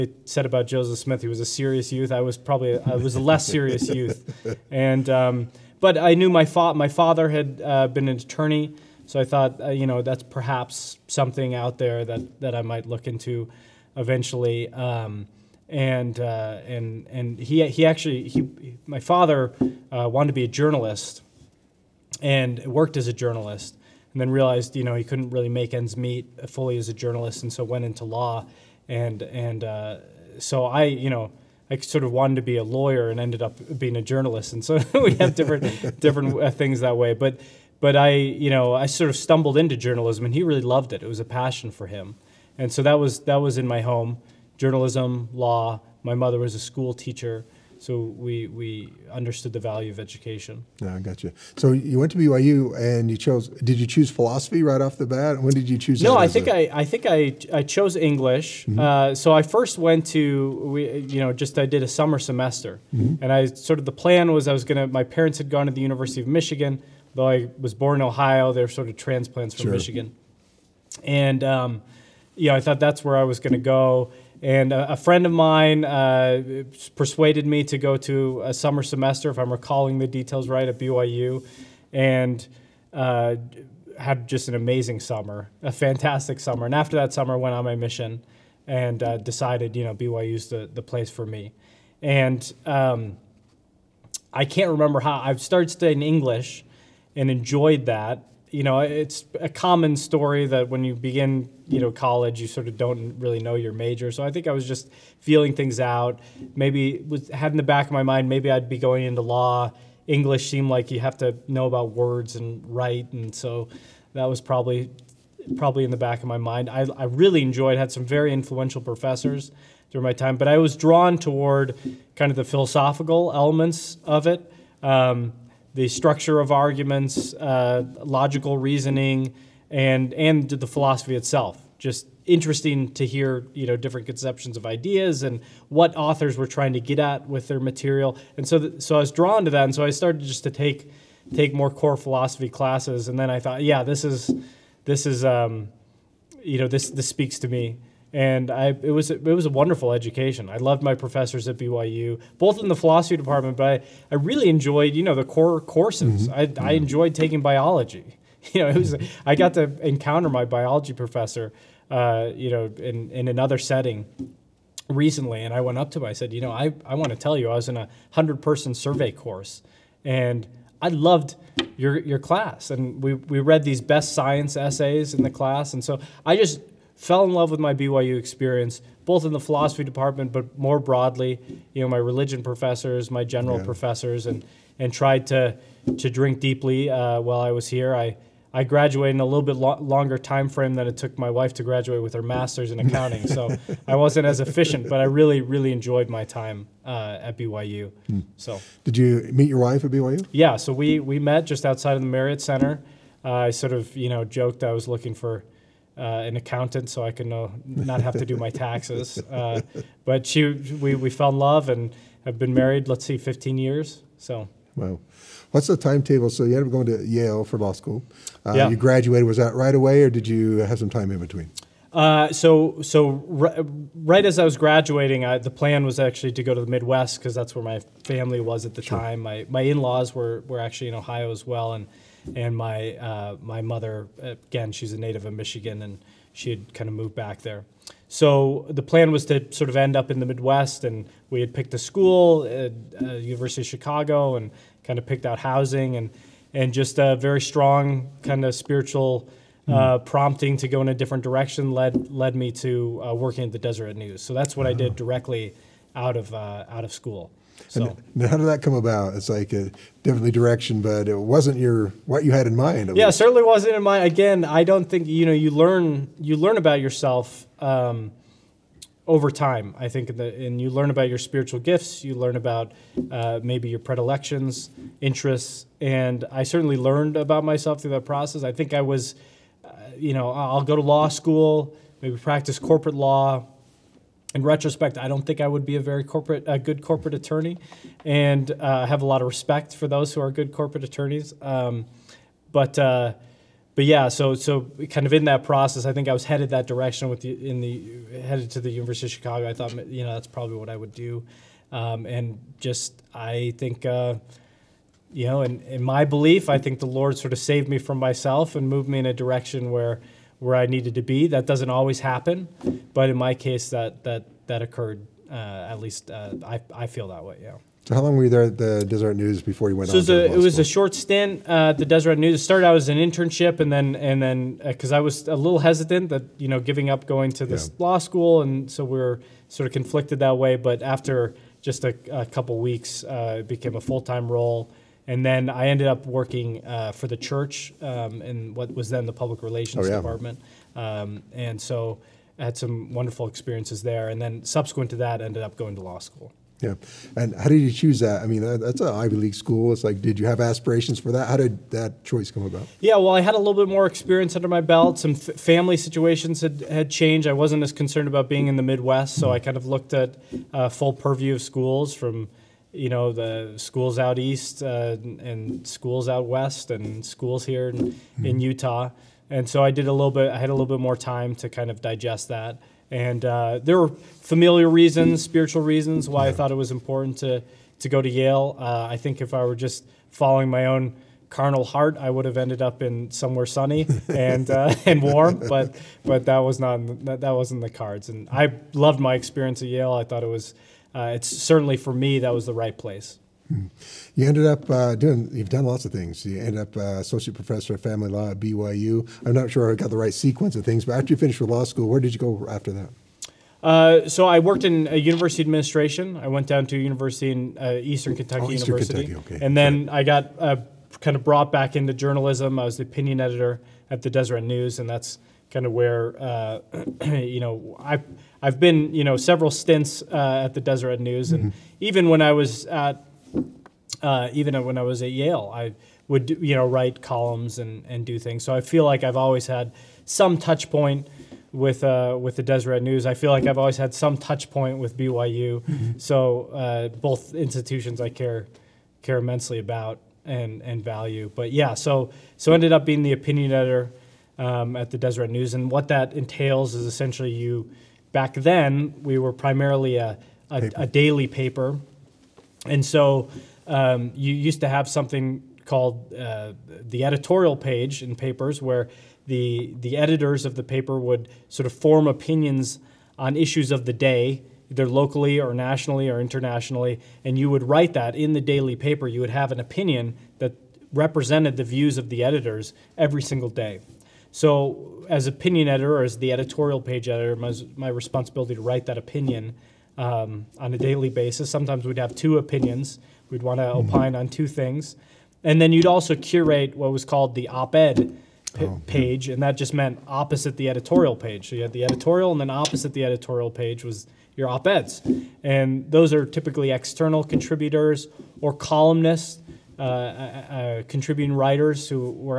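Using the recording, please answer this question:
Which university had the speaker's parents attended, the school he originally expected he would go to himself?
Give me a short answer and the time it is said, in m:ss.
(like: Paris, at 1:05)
University of Michigan, at 1:05.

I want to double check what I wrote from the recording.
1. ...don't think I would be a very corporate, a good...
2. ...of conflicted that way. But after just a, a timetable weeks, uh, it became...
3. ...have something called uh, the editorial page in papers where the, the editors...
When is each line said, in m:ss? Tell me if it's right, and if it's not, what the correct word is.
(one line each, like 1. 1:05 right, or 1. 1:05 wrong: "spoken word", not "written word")
1. 4:45 right
2. 5:29 wrong: "couple", not "timetable"
3. 7:34 right.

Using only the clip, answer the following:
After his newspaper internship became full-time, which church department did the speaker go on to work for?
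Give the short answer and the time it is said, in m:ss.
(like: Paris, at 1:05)
Public relations, at 5:39.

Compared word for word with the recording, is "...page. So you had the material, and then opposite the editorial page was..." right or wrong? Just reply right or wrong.
wrong.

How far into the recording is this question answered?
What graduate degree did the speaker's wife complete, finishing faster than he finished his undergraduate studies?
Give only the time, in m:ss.
3:12.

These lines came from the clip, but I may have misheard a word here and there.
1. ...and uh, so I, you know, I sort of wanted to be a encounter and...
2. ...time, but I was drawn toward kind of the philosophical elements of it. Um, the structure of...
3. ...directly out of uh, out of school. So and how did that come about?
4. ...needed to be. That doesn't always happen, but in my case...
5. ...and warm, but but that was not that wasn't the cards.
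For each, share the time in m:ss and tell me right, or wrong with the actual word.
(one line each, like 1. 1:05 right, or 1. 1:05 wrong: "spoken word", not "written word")
1. 0:29 wrong: "lawyer", not "encounter"
2. 2:00 right
3. 4:14 right
4. 5:10 right
5. 6:24 right.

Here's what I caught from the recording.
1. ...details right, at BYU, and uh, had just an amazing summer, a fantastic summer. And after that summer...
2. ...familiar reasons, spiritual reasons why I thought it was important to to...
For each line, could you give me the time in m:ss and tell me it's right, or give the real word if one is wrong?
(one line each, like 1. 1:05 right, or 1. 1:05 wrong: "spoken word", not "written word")
1. 1:20 right
2. 6:13 right.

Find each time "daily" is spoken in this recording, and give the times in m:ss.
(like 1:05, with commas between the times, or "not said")
7:30, 7:48, 8:00.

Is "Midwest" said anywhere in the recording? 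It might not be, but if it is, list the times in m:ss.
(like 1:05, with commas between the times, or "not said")
3:46, 4:00, 5:58.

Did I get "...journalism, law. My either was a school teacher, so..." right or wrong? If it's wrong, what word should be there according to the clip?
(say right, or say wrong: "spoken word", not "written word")
wrong: "mother", not "either".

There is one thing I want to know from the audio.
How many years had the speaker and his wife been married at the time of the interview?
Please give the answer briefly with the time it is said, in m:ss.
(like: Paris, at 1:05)
15, at 3:33.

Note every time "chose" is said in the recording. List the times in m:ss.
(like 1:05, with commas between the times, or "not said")
0:53, 0:57.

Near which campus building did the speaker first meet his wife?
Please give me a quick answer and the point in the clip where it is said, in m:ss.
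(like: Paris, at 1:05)
Marriott Center, at 3:22.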